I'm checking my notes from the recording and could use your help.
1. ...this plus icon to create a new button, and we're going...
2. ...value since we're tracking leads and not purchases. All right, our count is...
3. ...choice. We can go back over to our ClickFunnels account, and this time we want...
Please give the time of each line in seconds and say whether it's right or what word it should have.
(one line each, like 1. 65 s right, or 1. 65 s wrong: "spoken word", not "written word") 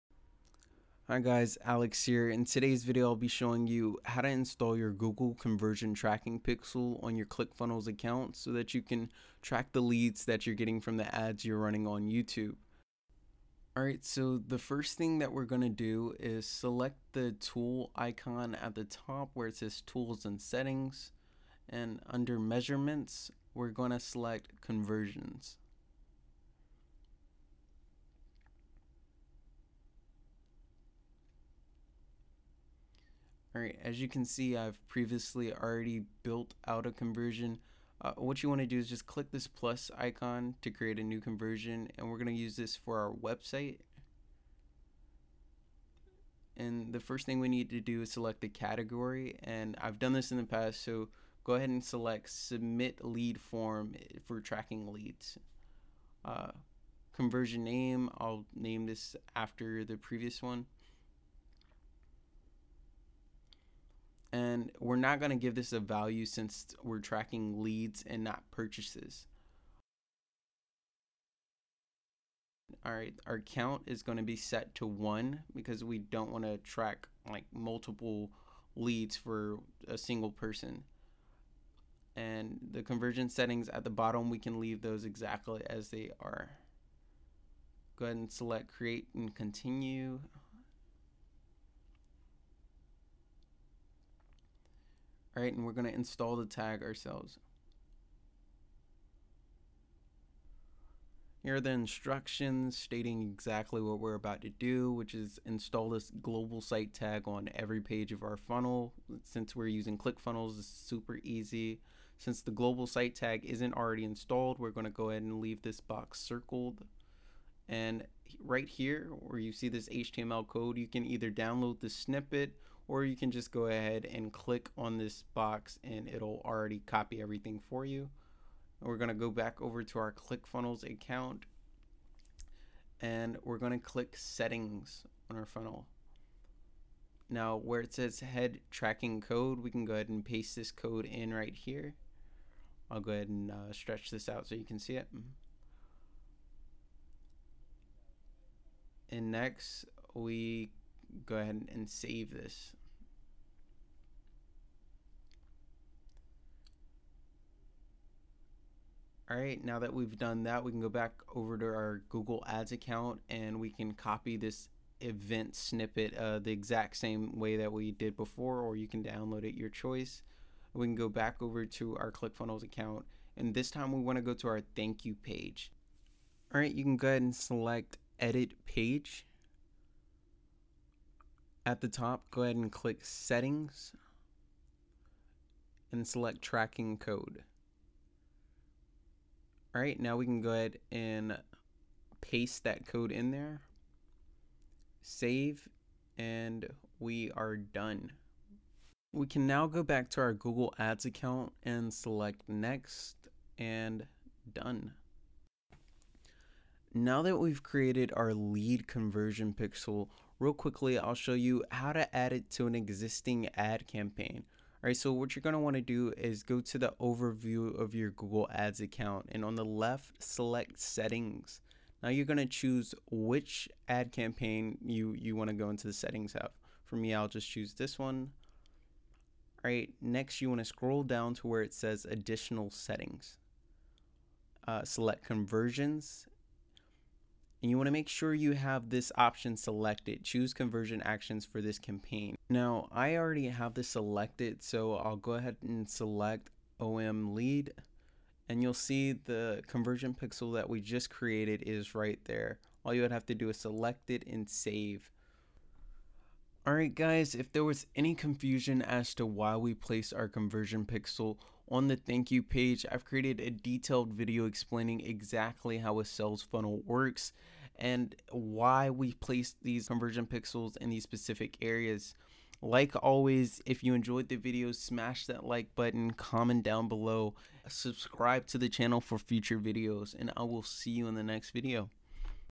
1. 39 s wrong: "conversion", not "button"
2. 65 s right
3. 169 s right.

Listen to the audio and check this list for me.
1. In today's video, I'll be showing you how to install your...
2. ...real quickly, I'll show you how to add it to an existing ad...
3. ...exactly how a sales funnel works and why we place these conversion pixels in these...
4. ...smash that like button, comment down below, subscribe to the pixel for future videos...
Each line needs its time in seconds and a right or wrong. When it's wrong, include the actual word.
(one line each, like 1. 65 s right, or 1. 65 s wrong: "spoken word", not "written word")
1. 2 s right
2. 210 s right
3. 264 s right
4. 274 s wrong: "channel", not "pixel".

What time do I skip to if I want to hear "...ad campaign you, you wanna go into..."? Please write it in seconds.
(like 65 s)
223 s.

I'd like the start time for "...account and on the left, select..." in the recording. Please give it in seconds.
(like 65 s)
218 s.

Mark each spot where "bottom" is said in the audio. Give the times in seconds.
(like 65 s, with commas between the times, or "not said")
83 s.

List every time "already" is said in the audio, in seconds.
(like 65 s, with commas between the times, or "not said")
35 s, 113 s, 126 s, 243 s.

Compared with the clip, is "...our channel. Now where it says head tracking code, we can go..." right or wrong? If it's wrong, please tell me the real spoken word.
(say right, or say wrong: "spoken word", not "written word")
wrong: "funnel", not "channel".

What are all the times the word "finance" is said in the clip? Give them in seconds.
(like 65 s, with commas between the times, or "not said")
not said.